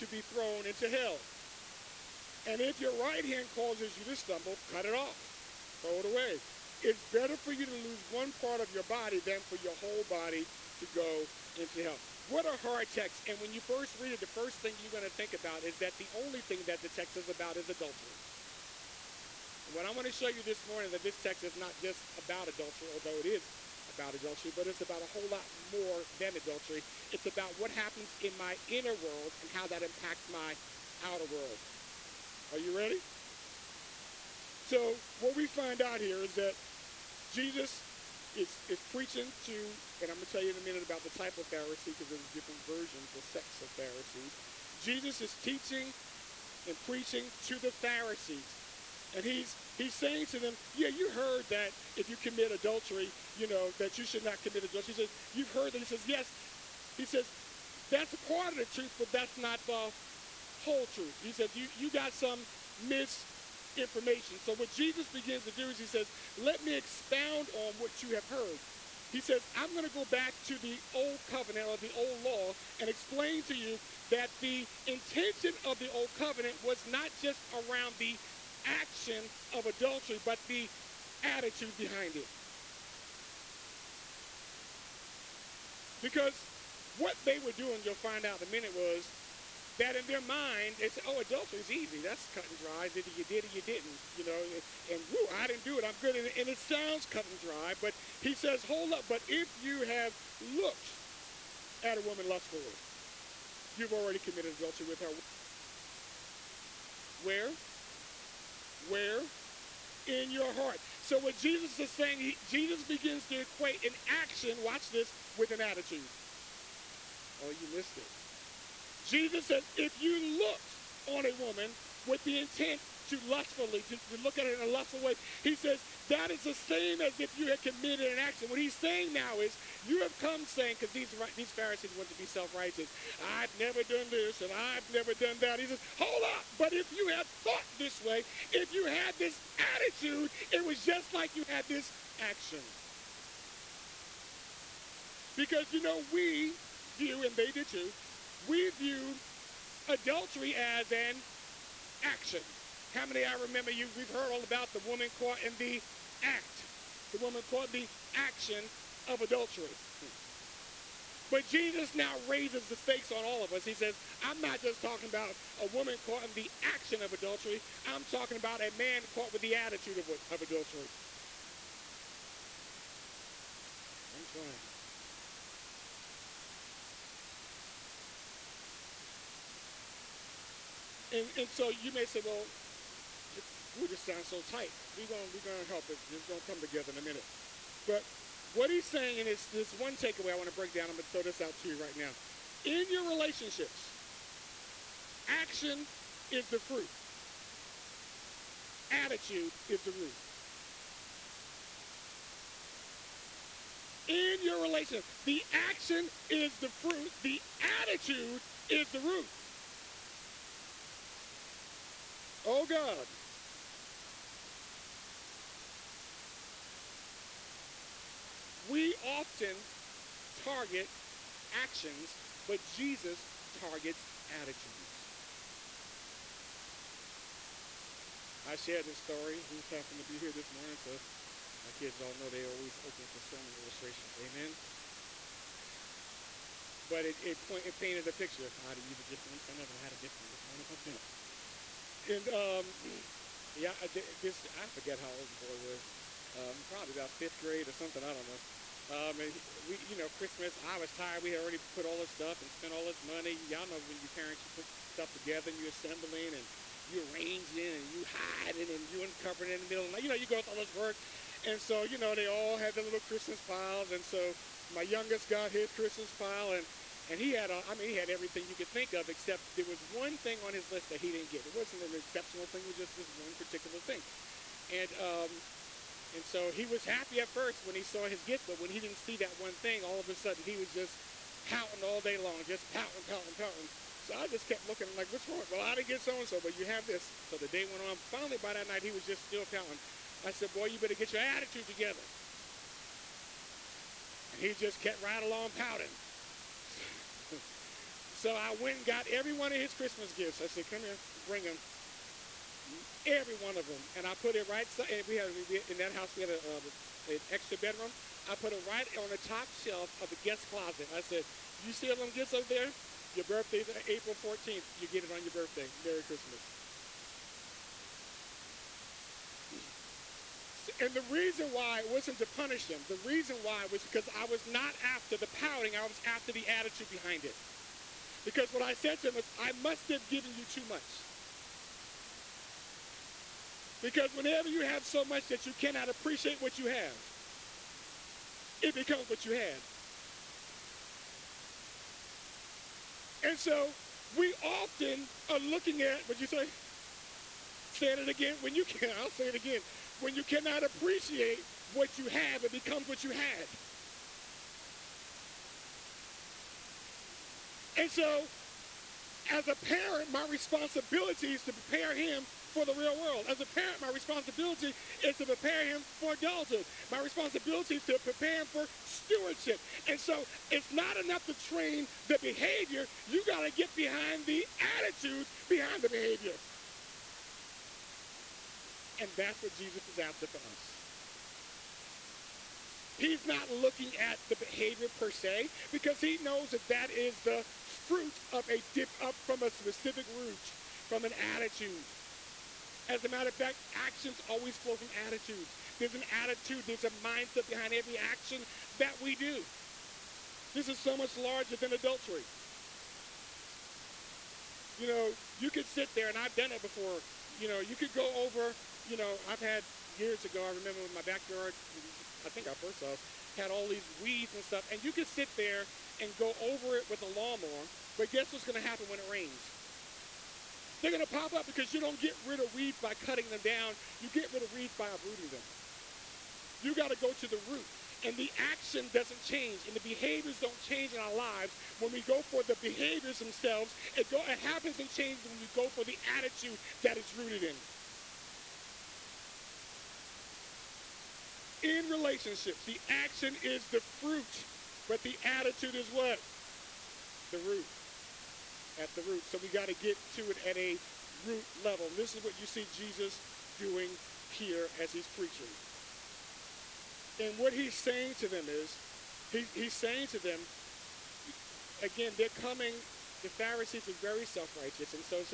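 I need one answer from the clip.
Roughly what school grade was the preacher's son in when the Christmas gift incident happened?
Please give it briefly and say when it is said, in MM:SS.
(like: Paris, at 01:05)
Fifth grade, at 04:07.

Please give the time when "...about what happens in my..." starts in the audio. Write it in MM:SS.
00:27.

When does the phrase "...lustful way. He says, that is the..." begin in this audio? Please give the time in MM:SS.
02:04.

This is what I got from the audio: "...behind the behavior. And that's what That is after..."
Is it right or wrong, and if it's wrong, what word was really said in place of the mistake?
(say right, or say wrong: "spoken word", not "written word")
wrong: "Jesus", not "That".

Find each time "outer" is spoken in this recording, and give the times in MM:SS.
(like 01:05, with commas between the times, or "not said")
00:31.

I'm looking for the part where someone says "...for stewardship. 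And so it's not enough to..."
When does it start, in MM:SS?
06:08.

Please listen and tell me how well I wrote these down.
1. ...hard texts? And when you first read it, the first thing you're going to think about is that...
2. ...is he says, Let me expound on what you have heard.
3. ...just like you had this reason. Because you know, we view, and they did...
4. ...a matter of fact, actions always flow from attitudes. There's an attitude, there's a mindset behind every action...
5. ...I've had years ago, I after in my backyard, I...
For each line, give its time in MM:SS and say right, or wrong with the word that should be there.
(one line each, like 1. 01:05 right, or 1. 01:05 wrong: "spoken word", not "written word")
1. 00:12 right
2. 01:05 right
3. 02:20 wrong: "action", not "reason"
4. 06:33 right
5. 06:49 wrong: "remember", not "after".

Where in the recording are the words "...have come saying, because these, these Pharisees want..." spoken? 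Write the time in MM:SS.
02:10.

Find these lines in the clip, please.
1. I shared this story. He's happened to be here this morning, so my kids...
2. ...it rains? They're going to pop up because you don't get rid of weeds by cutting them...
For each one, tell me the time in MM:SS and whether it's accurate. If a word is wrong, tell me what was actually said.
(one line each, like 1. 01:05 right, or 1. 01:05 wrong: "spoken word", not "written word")
1. 03:48 right
2. 06:58 right.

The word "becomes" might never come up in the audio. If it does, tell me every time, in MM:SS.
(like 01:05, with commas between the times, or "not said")
05:38, 05:52.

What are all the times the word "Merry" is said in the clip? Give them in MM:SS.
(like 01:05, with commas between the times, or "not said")
05:15.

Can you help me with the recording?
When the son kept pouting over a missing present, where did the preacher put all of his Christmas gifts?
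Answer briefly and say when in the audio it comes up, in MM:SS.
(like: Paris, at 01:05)
Top shelf of the guest closet, at 05:09.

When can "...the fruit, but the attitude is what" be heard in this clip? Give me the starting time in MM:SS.
07:23.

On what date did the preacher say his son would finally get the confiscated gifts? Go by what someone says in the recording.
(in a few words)
April 14.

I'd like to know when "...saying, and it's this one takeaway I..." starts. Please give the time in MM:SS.
03:08.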